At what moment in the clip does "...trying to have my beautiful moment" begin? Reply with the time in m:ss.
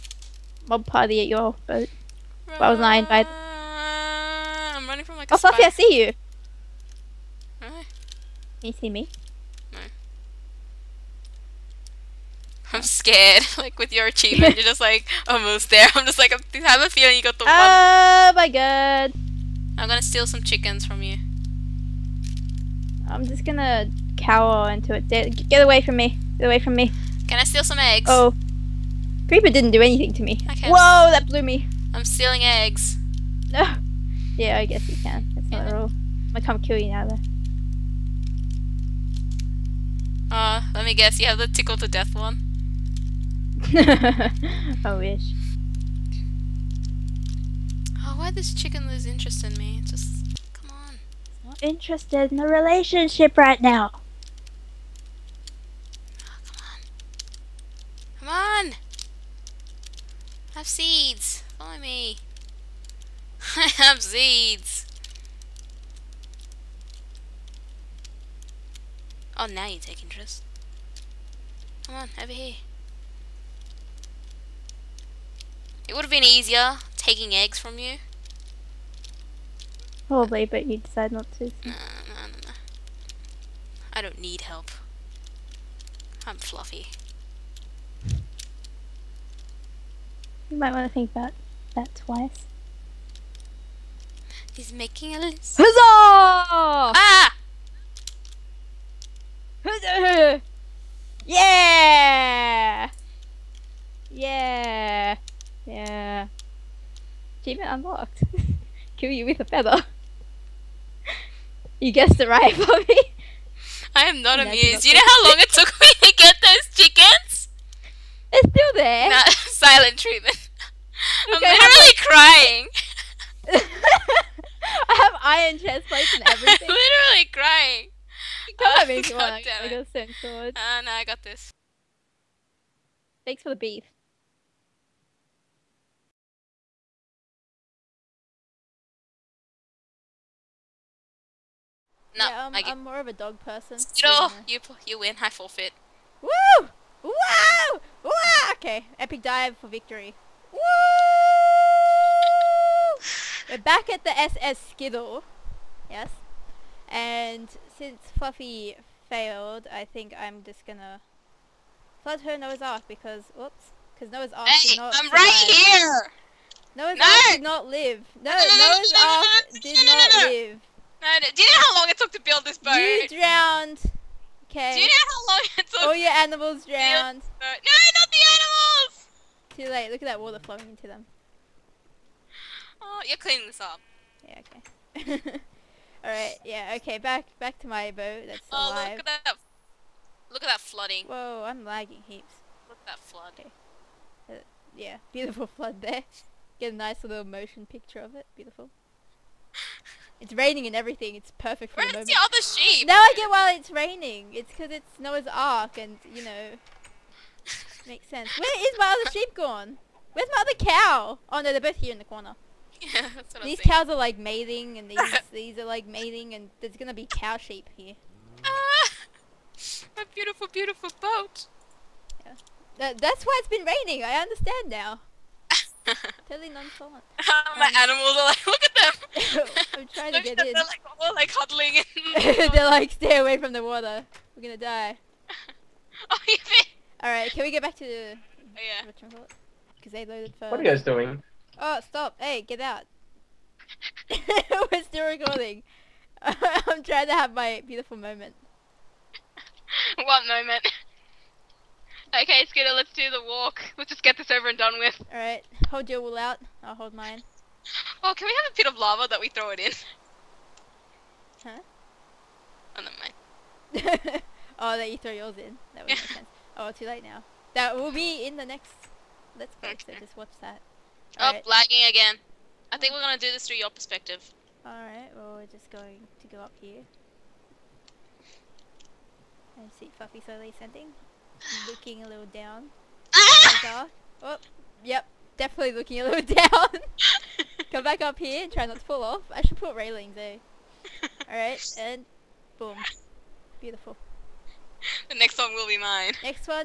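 4:06.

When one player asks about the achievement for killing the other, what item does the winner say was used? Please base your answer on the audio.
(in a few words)
A feather.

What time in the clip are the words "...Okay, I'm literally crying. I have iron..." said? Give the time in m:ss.
2:01.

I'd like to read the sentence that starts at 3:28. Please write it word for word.
Where is my other sheep gone?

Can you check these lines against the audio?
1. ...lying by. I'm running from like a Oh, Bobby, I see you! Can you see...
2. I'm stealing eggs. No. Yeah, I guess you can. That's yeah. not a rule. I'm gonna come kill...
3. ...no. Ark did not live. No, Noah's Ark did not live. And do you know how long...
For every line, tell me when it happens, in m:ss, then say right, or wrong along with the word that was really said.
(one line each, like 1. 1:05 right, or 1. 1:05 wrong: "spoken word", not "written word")
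1. 0:02 wrong: "Fluffy", not "Bobby"
2. 0:31 right
3. 2:46 right.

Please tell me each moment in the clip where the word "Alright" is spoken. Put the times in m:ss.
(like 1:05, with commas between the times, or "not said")
4:15, 4:34, 4:51.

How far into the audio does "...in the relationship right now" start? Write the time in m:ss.
0:52.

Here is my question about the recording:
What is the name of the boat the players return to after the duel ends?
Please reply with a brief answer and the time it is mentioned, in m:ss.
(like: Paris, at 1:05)
SS Skittle, at 2:34.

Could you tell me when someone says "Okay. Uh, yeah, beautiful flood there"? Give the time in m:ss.
3:13.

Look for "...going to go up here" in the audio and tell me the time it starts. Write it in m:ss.
4:35.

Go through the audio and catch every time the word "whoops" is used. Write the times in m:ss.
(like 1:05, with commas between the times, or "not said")
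2:43.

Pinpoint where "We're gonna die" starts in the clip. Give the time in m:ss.
3:54.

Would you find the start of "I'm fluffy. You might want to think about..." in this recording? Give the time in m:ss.
1:26.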